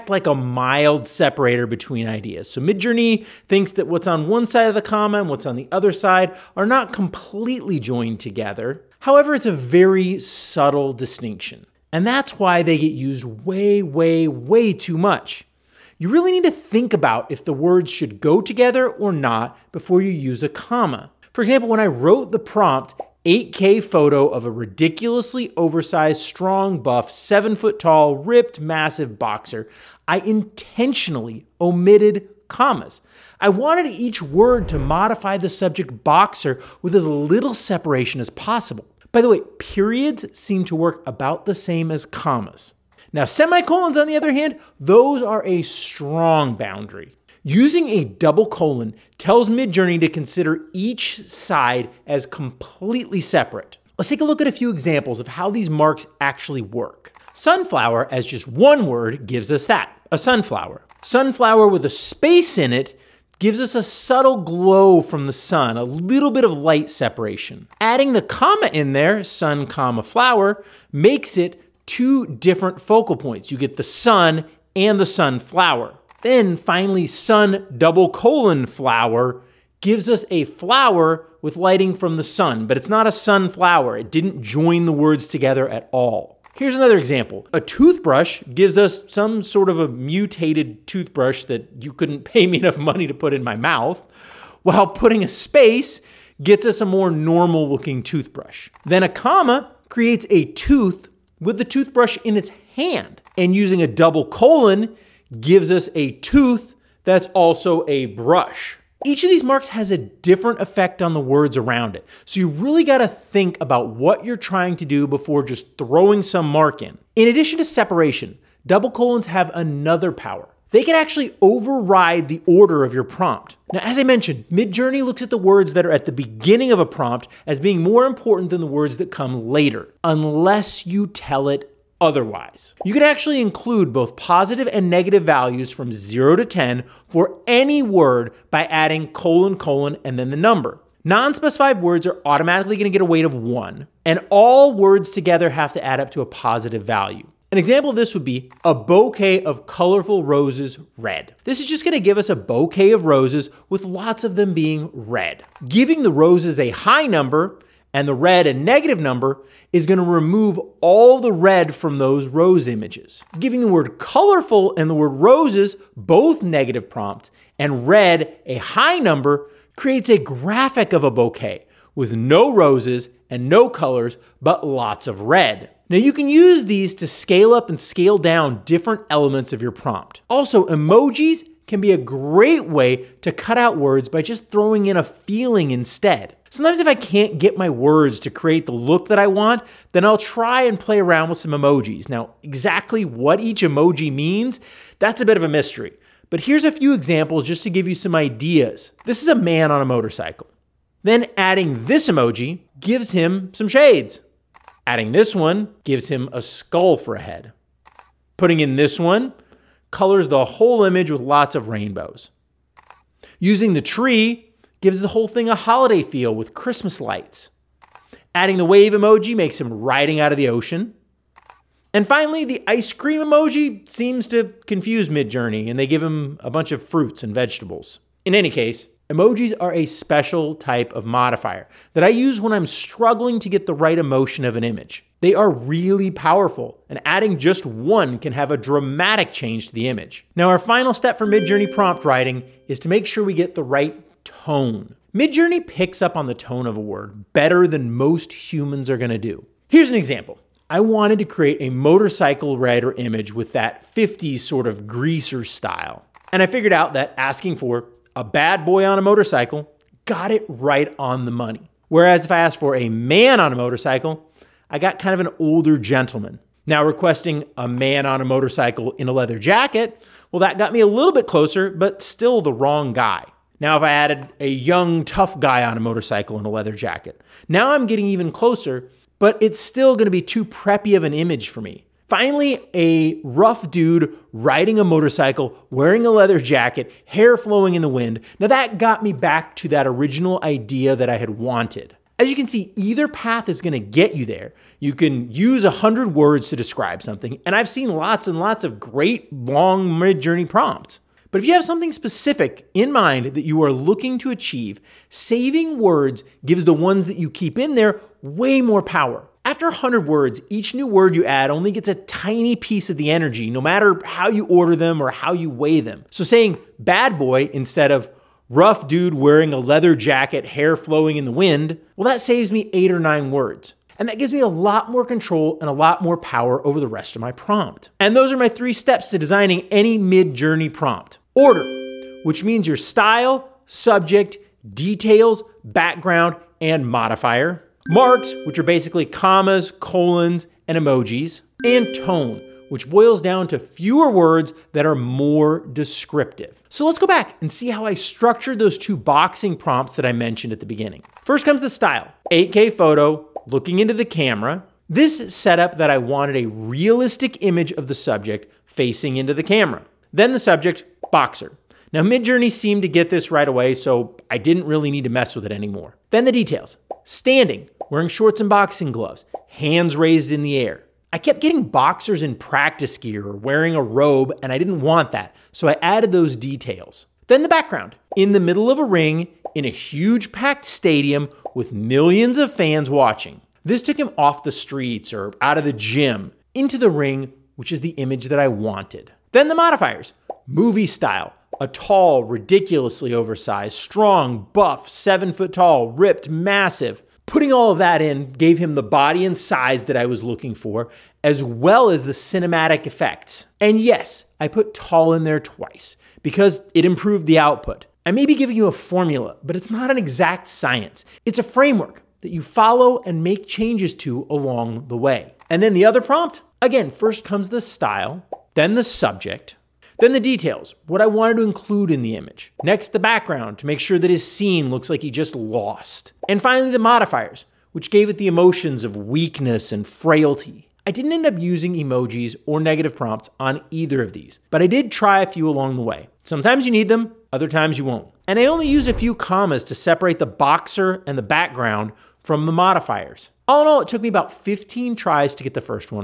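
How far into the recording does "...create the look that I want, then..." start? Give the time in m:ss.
3:08.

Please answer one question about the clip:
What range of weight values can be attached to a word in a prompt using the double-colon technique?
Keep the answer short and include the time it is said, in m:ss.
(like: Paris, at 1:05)
0 to 10, at 2:15.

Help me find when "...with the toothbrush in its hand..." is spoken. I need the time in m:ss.
1:41.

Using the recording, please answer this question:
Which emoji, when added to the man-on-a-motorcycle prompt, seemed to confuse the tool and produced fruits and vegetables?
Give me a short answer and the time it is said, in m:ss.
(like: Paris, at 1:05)
Ice cream emoji, at 3:42.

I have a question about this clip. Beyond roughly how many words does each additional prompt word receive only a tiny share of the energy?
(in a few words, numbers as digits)
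100.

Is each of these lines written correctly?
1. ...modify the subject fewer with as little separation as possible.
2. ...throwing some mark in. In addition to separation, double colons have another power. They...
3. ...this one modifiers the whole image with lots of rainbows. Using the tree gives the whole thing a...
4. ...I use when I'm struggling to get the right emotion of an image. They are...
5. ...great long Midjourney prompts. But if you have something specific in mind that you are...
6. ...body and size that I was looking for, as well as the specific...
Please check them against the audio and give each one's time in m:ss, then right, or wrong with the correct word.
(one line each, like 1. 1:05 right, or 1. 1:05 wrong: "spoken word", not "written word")
1. 0:34 wrong: "boxer", not "fewer"
2. 1:55 right
3. 3:28 wrong: "colors", not "modifiers"
4. 3:52 right
5. 4:58 right
6. 6:38 wrong: "cinematic", not "specific".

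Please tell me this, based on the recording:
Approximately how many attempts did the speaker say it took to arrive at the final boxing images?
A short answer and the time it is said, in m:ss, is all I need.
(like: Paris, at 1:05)
15, at 7:24.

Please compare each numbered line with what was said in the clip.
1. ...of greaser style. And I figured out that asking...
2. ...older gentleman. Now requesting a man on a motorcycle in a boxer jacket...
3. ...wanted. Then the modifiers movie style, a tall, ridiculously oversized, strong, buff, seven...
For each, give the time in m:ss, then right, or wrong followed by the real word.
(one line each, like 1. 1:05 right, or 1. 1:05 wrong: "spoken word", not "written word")
1. 4:14 right
2. 4:25 wrong: "leather", not "boxer"
3. 6:28 right.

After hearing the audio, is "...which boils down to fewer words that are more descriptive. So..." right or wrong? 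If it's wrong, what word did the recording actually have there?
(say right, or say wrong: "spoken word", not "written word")
right.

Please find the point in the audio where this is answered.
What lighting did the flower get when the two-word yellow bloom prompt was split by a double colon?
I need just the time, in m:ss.
1:21.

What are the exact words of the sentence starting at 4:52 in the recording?
As you can see, either path is going to get you there.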